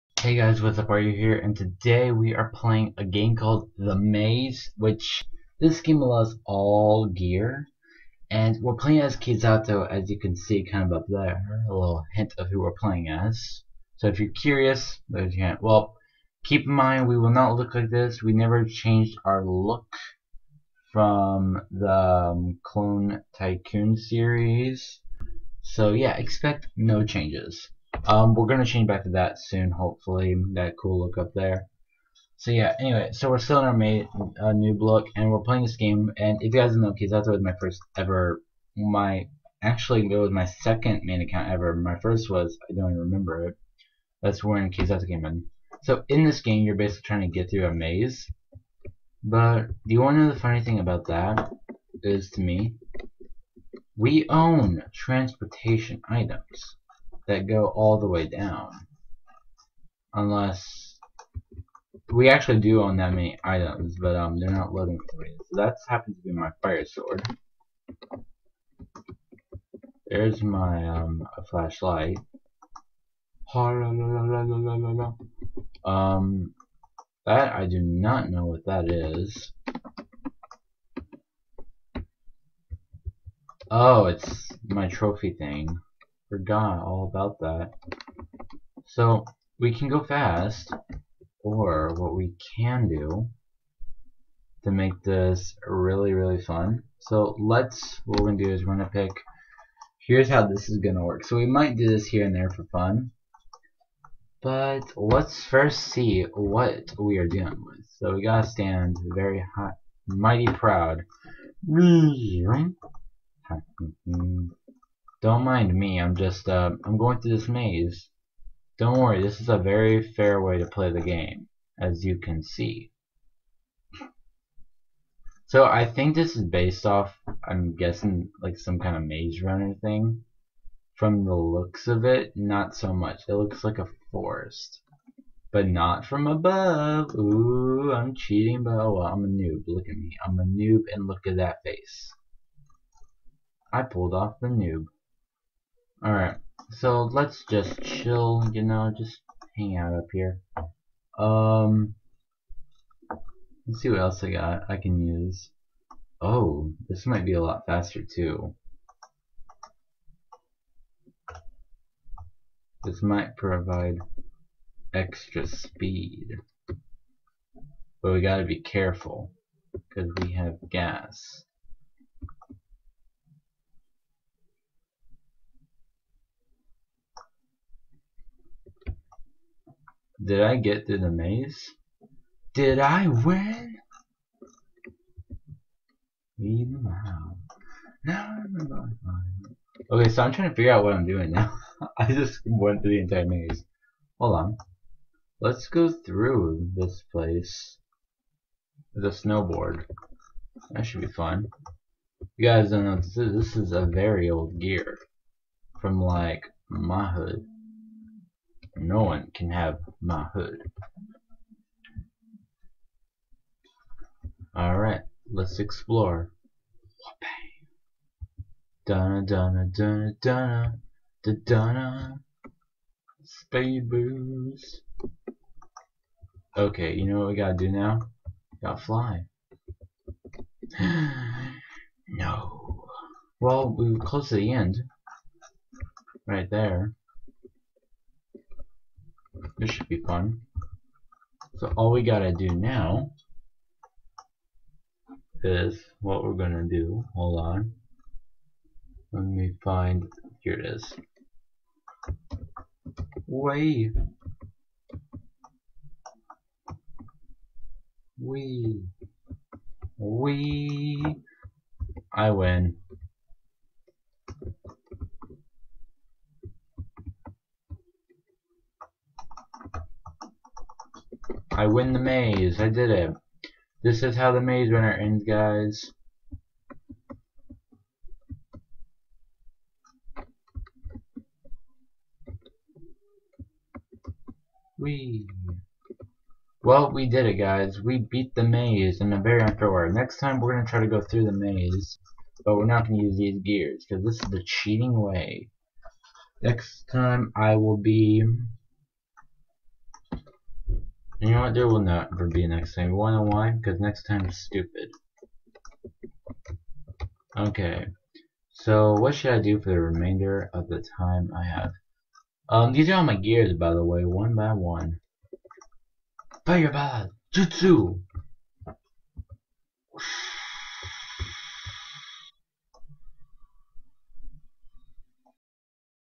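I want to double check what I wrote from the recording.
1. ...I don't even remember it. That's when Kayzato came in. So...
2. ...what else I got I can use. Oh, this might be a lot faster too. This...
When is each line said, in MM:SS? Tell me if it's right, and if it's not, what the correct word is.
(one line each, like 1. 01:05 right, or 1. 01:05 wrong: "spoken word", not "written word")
1. 00:42 right
2. 02:33 right.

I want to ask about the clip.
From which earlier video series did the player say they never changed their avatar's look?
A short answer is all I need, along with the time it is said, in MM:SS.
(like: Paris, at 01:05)
Clone Tycoon, at 00:22.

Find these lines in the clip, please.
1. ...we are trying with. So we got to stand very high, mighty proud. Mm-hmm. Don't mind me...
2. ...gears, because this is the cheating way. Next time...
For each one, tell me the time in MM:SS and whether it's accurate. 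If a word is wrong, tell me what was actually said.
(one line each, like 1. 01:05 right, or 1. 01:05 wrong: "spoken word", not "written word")
1. 01:46 wrong: "dealing", not "trying"
2. 04:53 right.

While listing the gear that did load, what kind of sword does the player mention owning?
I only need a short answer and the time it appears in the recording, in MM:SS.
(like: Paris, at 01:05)
Fire sword, at 01:06.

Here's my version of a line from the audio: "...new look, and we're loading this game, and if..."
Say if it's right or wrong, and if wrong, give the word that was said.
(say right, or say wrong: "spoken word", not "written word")
wrong: "playing", not "loading".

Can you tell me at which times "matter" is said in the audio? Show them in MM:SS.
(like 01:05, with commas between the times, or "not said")
not said.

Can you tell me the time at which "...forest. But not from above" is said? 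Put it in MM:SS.
02:14.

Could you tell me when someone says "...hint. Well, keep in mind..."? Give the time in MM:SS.
00:15.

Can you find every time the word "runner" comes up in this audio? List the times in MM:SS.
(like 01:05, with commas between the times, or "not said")
02:09, 04:34.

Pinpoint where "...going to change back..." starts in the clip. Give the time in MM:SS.
00:28.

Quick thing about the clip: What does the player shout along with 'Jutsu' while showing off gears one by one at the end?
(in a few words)
Fireball.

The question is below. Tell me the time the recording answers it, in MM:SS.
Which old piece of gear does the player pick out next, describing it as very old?
03:18.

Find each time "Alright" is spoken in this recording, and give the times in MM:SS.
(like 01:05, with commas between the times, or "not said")
02:26, 03:34.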